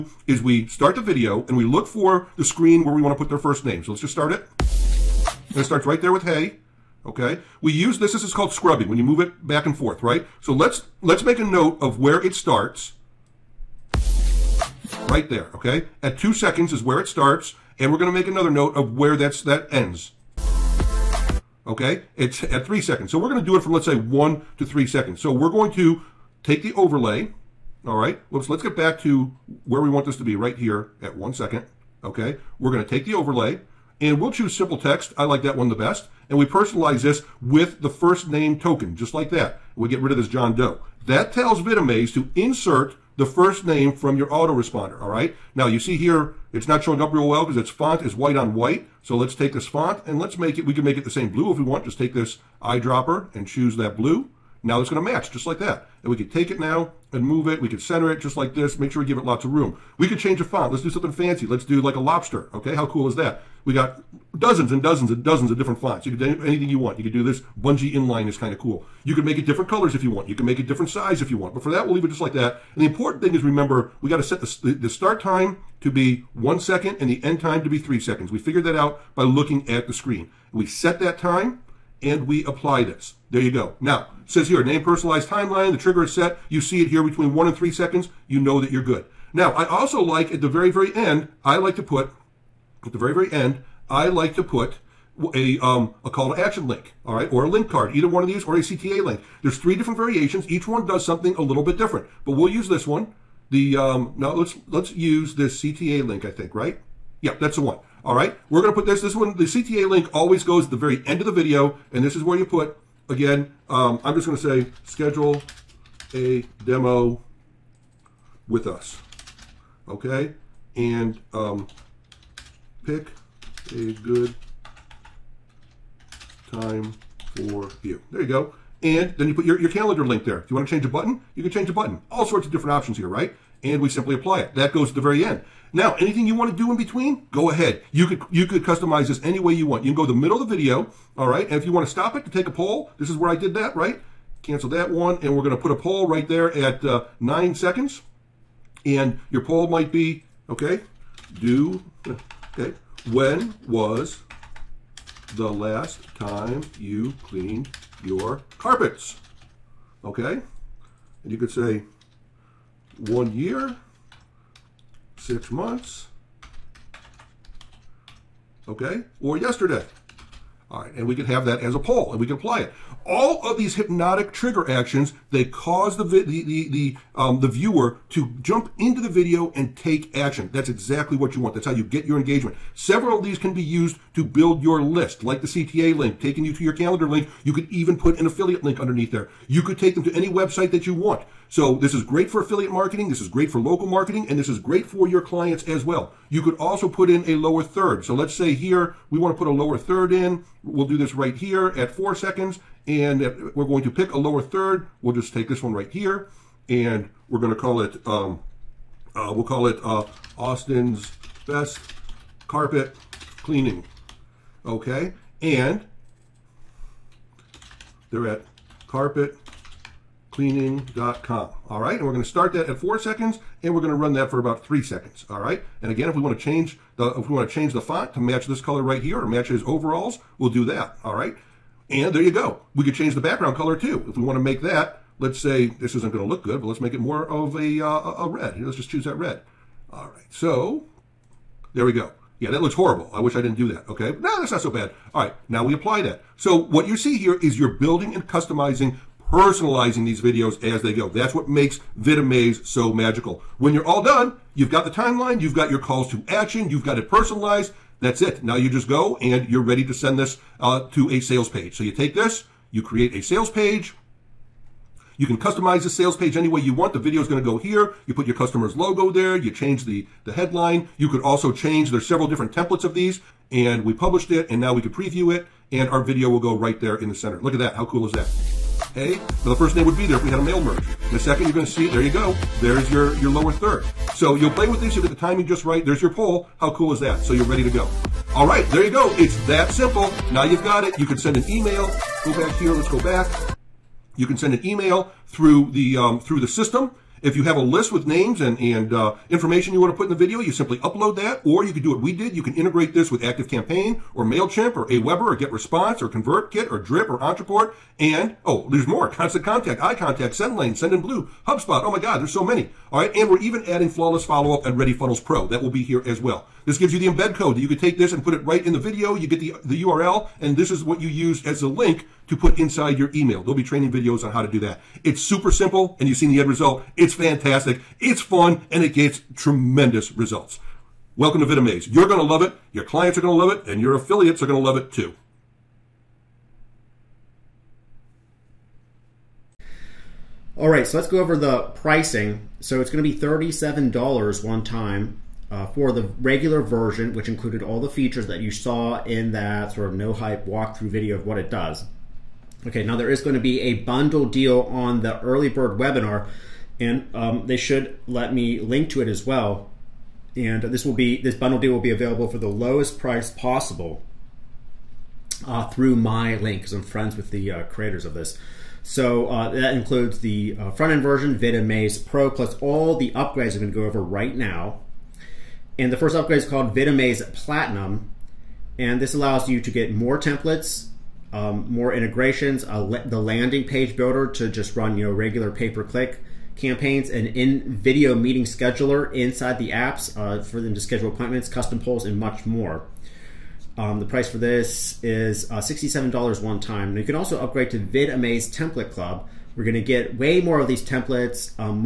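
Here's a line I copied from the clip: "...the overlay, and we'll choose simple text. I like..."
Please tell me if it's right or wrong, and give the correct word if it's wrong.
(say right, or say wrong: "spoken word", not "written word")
right.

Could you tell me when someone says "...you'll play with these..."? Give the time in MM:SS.
04:44.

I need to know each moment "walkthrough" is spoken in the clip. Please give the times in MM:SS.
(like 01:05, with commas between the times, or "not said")
05:50.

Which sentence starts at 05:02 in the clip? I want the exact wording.
You can integrate this with ActiveCampaign or MailChimp or Aweber or GetResponse or ConvertKit or Drip or Ontraport.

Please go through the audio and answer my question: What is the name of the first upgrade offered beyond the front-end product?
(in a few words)
VidAmaze Platinum.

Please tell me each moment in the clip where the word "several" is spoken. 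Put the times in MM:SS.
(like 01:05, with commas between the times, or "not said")
03:02, 04:32.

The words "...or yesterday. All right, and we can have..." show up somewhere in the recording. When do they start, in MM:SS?
02:49.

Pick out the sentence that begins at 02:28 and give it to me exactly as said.
And your poll might be, okay, do, okay, when was the last time you cleaned your carpets?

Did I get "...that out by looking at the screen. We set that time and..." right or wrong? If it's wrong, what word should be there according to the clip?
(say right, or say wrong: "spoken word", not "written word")
right.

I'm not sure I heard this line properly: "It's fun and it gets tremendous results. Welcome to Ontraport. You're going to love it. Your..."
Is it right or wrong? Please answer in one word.
wrong.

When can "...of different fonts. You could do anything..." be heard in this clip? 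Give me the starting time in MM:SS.
01:05.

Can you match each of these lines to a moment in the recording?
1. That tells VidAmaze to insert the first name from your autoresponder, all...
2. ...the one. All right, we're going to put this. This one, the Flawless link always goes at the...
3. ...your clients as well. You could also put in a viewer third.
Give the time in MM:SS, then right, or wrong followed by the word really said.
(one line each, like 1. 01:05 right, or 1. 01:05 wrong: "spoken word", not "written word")
1. 00:41 right
2. 01:47 wrong: "CTA", not "Flawless"
3. 03:15 wrong: "lower", not "viewer".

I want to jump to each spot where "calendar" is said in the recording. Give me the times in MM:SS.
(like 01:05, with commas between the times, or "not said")
02:09, 03:06.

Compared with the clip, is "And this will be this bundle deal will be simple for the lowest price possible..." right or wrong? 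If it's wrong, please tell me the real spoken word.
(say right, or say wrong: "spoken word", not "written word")
wrong: "available", not "simple".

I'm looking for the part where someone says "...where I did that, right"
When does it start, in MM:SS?
02:23.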